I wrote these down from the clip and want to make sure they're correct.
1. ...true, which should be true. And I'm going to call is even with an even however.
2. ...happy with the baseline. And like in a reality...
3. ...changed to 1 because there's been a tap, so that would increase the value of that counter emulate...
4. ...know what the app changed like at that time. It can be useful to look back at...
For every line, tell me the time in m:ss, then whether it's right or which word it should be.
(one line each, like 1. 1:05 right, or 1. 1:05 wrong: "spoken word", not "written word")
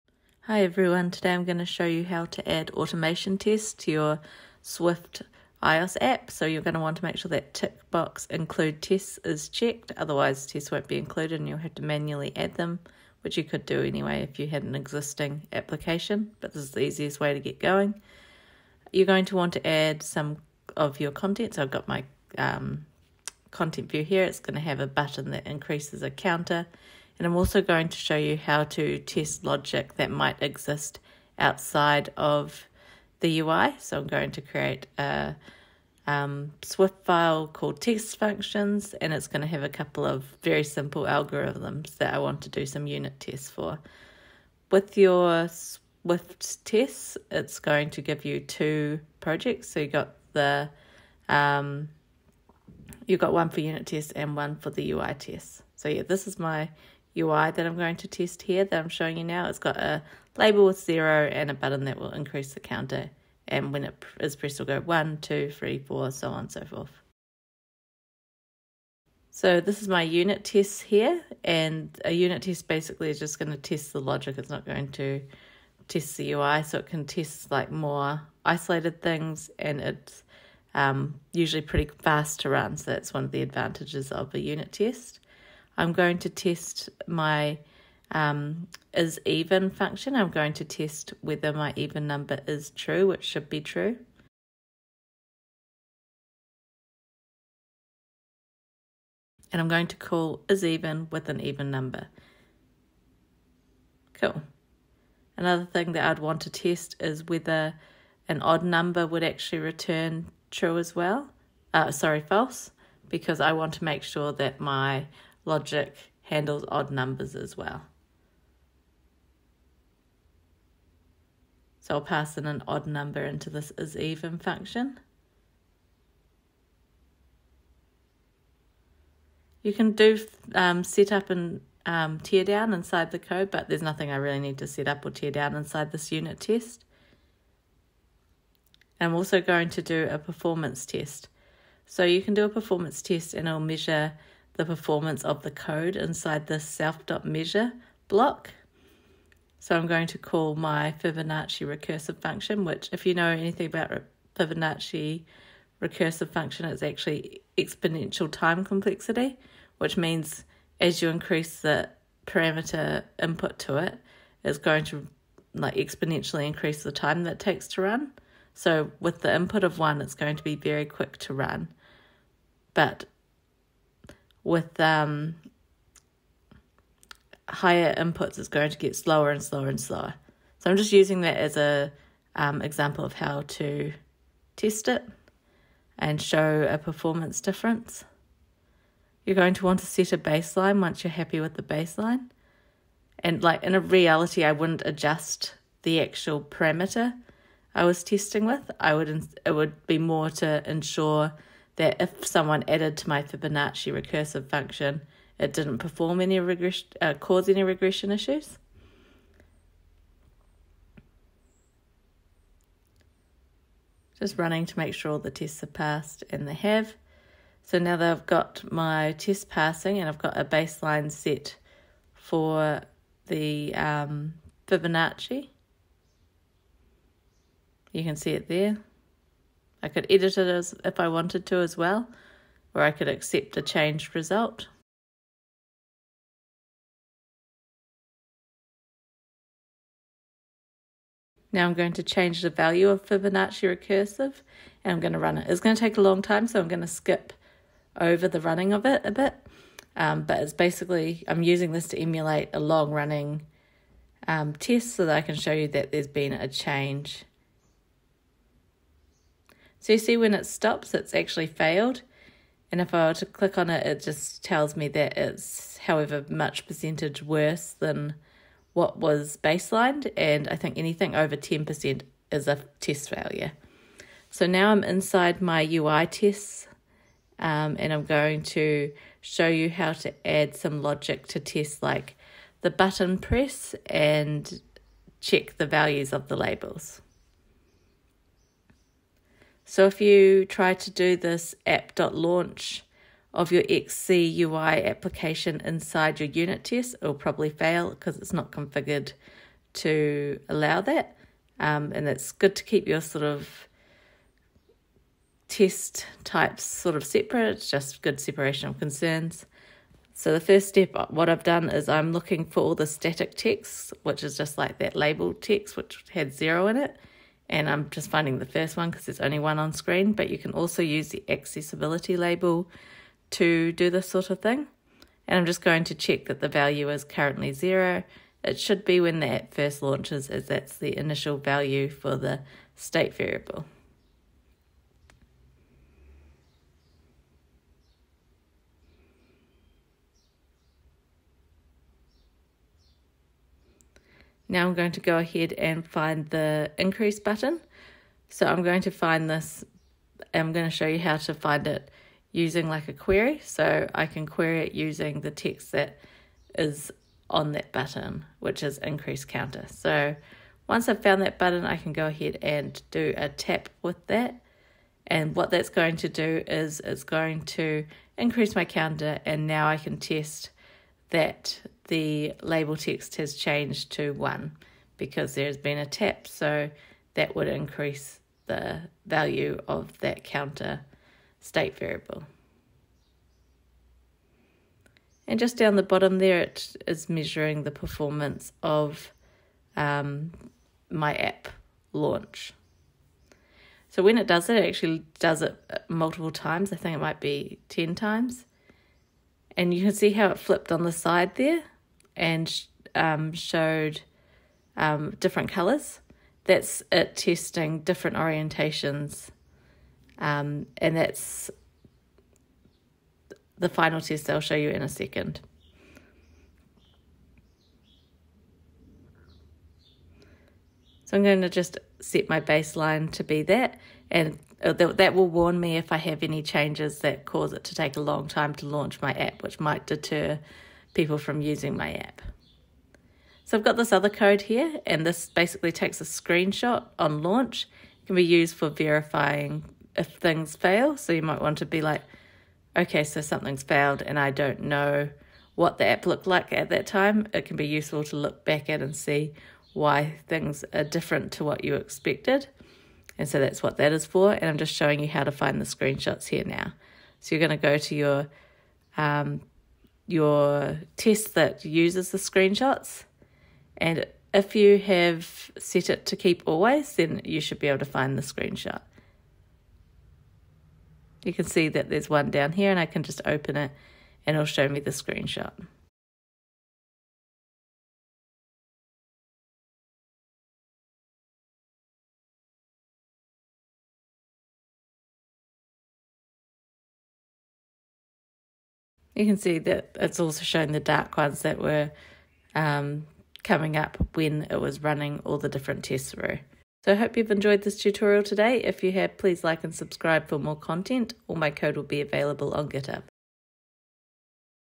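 1. 1:32 wrong: "number", not "however"
2. 3:11 right
3. 6:13 wrong: "state", not "emulate"
4. 7:24 wrong: "looked", not "changed".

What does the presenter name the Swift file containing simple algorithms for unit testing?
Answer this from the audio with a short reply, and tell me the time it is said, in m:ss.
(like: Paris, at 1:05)
test functions, at 0:37.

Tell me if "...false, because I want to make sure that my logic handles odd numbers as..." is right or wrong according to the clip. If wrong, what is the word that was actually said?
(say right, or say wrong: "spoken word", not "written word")
right.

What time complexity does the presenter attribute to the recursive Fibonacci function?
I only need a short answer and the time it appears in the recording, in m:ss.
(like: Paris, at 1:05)
Exponential, at 2:37.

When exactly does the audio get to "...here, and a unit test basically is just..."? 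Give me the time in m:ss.
1:10.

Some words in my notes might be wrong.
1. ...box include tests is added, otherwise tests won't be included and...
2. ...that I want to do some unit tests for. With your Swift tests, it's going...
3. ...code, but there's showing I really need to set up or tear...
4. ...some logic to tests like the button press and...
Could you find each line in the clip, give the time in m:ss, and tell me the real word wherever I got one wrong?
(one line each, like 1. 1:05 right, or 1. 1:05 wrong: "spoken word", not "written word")
1. 0:07 wrong: "checked", not "added"
2. 0:41 right
3. 2:13 wrong: "nothing", not "showing"
4. 4:40 right.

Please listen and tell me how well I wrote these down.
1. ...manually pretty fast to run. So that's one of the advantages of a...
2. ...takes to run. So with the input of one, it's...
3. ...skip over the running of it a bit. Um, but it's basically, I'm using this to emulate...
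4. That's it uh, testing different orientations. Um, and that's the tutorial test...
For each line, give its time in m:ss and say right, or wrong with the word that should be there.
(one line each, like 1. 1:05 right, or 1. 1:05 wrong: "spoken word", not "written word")
1. 1:21 wrong: "usually", not "manually"
2. 2:47 right
3. 4:06 right
4. 6:46 wrong: "final", not "tutorial".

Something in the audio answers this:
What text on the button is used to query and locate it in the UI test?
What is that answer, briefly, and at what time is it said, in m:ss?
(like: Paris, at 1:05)
increase counter, at 5:58.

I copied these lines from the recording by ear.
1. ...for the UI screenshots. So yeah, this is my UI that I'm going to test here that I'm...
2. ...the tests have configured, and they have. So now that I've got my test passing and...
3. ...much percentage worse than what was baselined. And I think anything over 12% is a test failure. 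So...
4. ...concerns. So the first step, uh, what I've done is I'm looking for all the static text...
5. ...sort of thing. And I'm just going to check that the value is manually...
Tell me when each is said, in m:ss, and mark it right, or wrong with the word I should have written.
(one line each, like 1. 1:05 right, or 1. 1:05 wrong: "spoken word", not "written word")
1. 0:54 wrong: "tests", not "screenshots"
2. 3:35 wrong: "passed", not "configured"
3. 4:26 wrong: "10", not "12"
4. 5:08 right
5. 5:24 wrong: "currently", not "manually".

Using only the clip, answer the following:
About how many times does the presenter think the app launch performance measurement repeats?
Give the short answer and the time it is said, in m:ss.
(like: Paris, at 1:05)
10, at 6:37.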